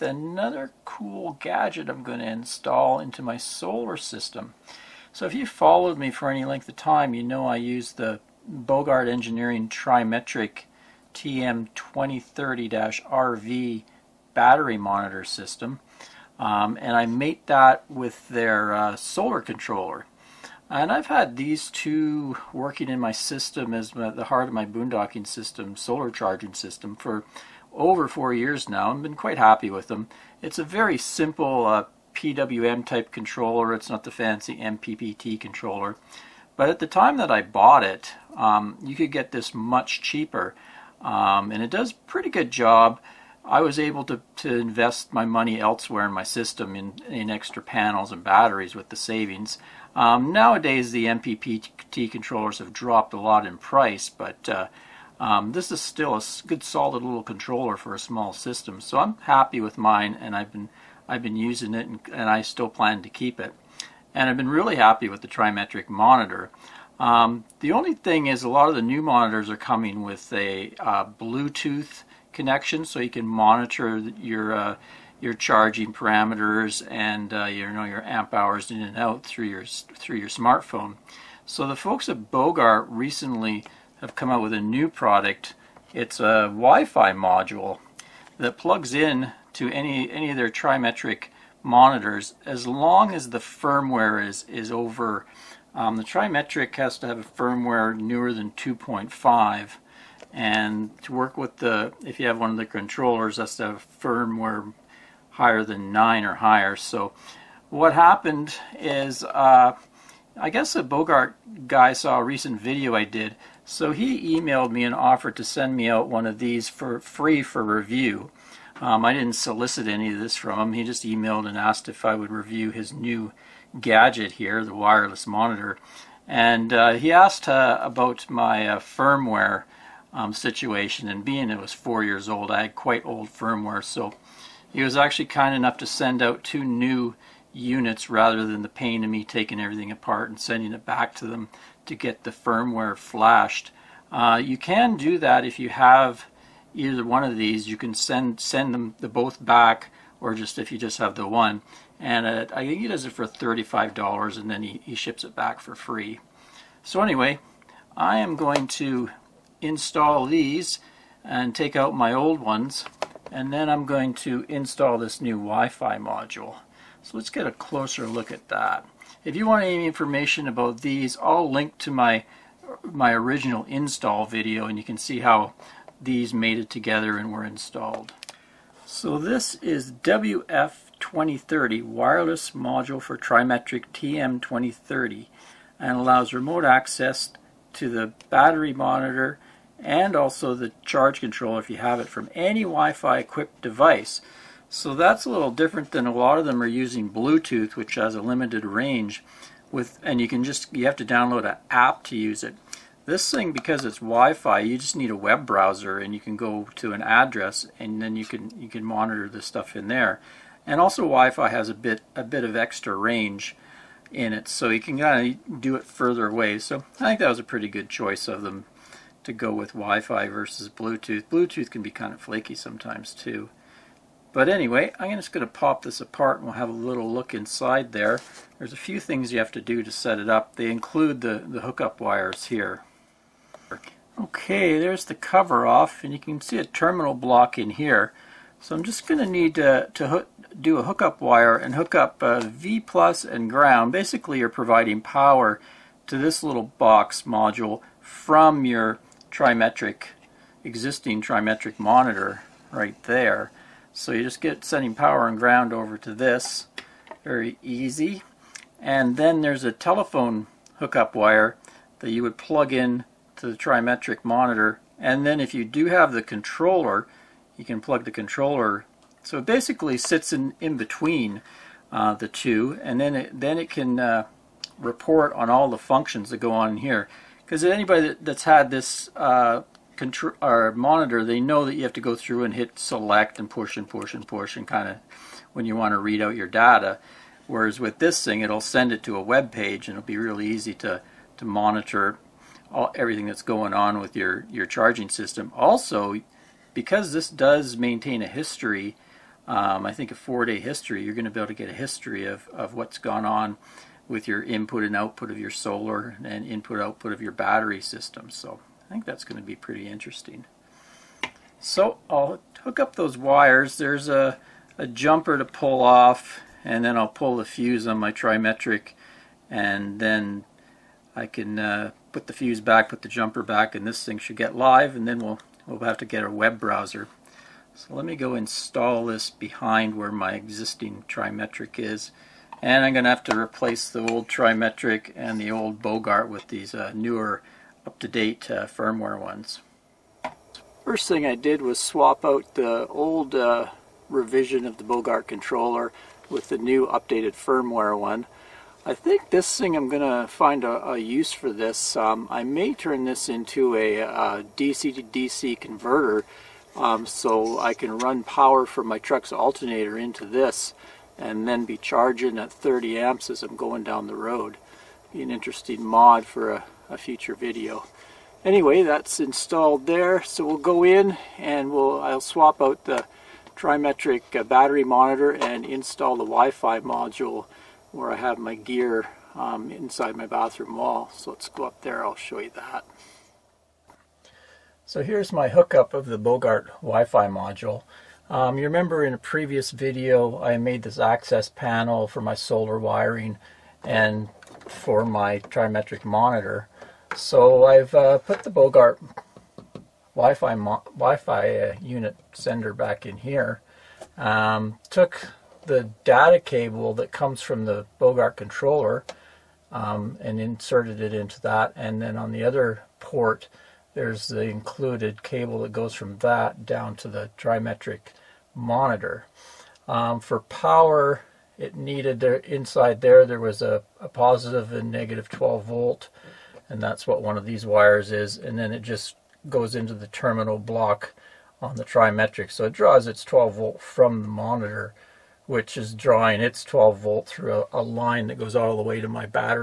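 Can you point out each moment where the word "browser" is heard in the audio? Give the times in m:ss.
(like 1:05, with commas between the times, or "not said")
3:25, 5:26.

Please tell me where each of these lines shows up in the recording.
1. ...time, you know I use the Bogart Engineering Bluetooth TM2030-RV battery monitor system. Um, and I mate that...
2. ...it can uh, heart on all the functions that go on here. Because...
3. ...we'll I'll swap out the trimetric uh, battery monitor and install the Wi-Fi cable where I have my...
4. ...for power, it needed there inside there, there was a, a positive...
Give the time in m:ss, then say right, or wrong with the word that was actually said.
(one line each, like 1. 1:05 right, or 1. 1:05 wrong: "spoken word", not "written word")
1. 0:06 wrong: "Trimetric", not "Bluetooth"
2. 4:33 wrong: "report", not "heart"
3. 6:11 wrong: "module", not "cable"
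4. 7:00 right.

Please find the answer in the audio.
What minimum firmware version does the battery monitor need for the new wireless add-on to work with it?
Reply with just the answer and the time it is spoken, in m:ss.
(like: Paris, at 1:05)
2.5, at 1:38.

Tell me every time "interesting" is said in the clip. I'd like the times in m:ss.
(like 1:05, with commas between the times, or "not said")
5:09, 6:05.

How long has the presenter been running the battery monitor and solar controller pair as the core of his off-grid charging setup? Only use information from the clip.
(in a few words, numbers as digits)
over four years.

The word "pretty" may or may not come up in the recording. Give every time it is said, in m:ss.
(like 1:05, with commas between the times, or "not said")
0:41, 3:37, 5:09.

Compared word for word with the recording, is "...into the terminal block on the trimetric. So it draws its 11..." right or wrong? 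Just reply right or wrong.
wrong.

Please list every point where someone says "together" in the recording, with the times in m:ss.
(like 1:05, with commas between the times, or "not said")
2:56.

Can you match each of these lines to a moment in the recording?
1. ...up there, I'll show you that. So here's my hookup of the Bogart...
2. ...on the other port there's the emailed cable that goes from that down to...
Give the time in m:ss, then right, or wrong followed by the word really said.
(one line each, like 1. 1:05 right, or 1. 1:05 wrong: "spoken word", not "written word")
1. 6:21 right
2. 6:52 wrong: "included", not "emailed".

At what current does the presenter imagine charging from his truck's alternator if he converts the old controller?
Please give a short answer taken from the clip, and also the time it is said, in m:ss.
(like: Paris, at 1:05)
30 amps, at 6:02.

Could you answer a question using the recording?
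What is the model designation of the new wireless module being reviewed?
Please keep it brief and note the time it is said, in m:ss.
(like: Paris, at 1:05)
WF 2030, at 2:59.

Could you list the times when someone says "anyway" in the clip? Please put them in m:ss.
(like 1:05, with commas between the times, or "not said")
2:36, 3:44, 6:08.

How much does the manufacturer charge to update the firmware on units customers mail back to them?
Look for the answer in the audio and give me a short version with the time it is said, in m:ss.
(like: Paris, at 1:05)
$35, at 2:33.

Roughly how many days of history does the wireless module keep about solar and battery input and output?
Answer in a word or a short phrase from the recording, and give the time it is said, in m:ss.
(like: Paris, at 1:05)
4, at 5:00.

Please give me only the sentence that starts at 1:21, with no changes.
So the folks at Bogart recently have come out with a new product.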